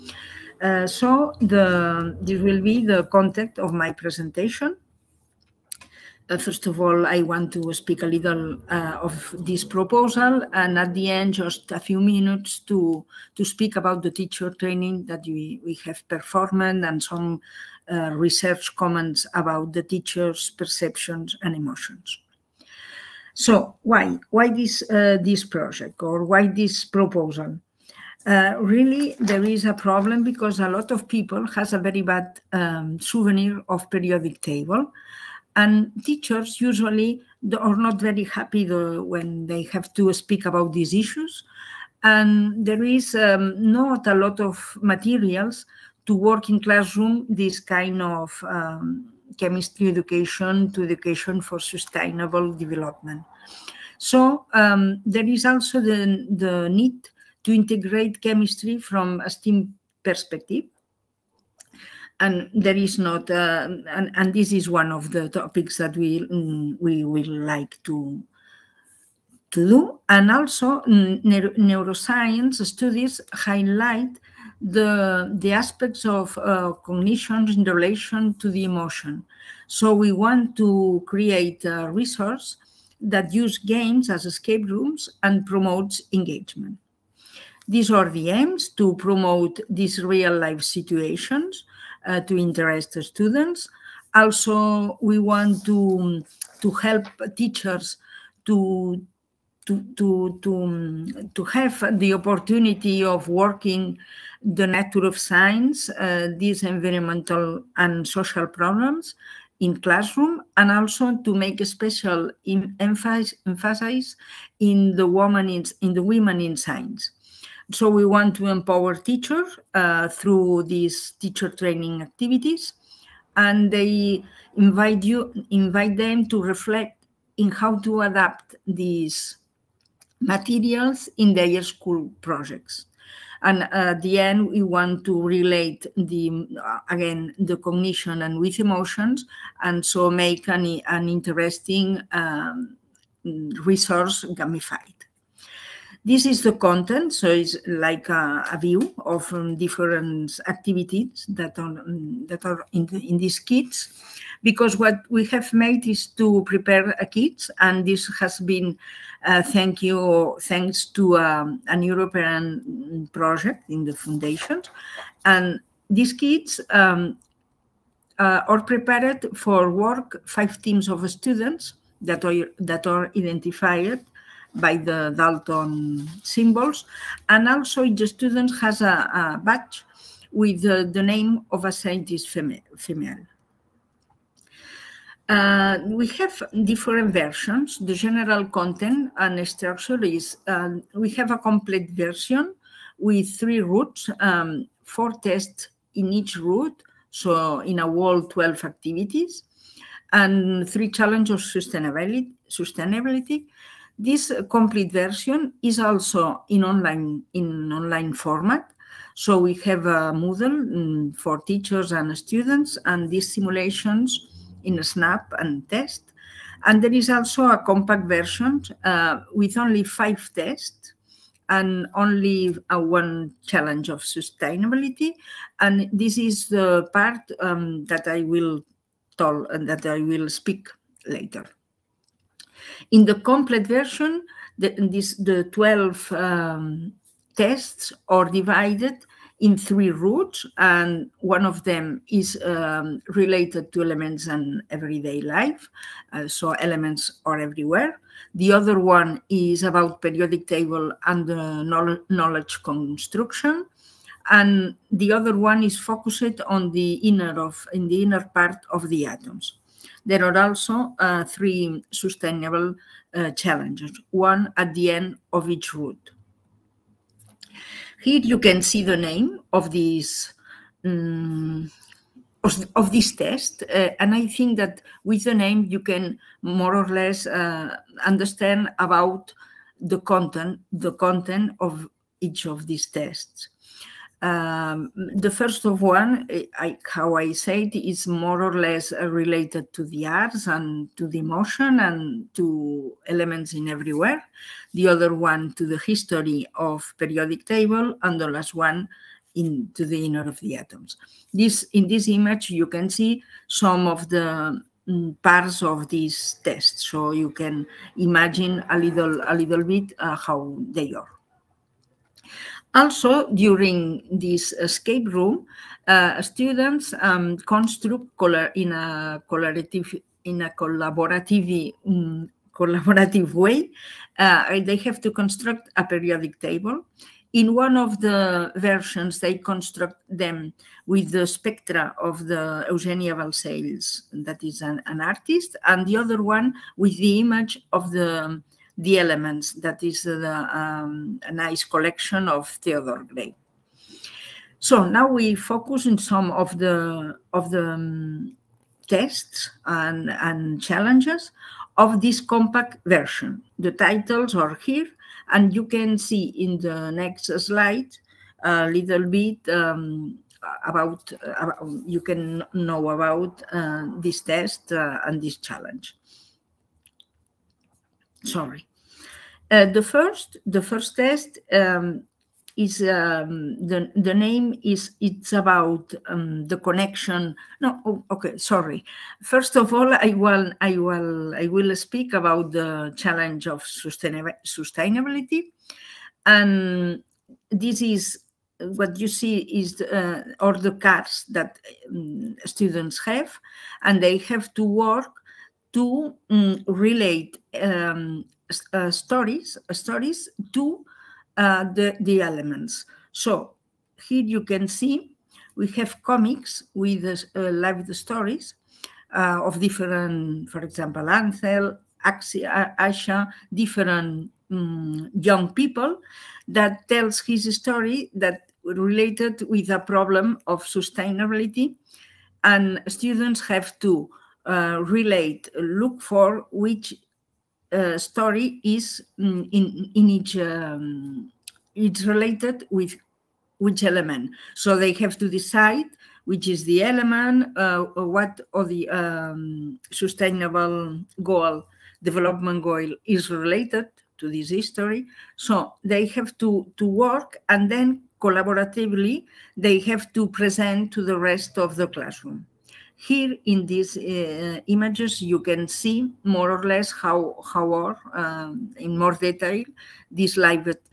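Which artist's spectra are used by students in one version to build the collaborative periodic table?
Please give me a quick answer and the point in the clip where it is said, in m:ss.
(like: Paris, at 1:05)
Eugenia Balcells, at 5:32.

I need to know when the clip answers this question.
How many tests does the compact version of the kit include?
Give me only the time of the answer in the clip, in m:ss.
3:39.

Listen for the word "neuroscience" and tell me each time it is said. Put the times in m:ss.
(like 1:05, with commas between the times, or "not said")
1:11.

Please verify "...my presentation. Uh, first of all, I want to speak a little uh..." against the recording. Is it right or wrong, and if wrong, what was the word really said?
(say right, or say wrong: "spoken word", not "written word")
right.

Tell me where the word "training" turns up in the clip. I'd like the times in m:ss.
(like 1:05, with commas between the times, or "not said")
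0:14, 2:01.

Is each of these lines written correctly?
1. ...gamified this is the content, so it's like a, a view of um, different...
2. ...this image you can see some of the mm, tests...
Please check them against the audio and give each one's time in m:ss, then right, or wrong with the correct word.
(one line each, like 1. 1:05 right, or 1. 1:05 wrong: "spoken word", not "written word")
1. 2:24 right
2. 5:01 wrong: "parts", not "tests".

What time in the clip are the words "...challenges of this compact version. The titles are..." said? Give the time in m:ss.
5:50.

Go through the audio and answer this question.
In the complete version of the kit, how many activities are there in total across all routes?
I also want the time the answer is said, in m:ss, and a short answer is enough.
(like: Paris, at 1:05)
12, at 3:18.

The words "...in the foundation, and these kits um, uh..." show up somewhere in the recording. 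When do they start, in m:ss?
2:43.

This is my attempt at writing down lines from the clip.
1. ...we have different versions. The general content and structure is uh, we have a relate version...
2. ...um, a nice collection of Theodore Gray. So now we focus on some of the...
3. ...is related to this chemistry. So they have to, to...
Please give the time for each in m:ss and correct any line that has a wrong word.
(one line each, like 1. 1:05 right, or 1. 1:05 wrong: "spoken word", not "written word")
1. 3:05 wrong: "complete", not "relate"
2. 5:40 right
3. 7:23 wrong: "history", not "chemistry".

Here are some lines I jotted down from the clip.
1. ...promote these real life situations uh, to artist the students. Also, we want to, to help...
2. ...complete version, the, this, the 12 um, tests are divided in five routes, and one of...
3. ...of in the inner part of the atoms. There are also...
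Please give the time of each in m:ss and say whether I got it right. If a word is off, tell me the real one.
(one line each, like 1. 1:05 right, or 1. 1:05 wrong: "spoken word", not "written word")
1. 1:28 wrong: "interest", not "artist"
2. 3:53 wrong: "three", not "five"
3. 4:17 right.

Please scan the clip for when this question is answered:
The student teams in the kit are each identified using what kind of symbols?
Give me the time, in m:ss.
2:55.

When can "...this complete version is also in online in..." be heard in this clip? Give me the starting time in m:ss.
3:23.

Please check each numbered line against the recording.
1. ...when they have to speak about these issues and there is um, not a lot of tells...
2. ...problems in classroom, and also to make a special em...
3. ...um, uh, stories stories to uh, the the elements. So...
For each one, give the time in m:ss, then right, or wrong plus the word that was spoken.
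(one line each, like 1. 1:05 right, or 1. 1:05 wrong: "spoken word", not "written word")
1. 0:38 wrong: "materials", not "tells"
2. 1:48 right
3. 6:37 right.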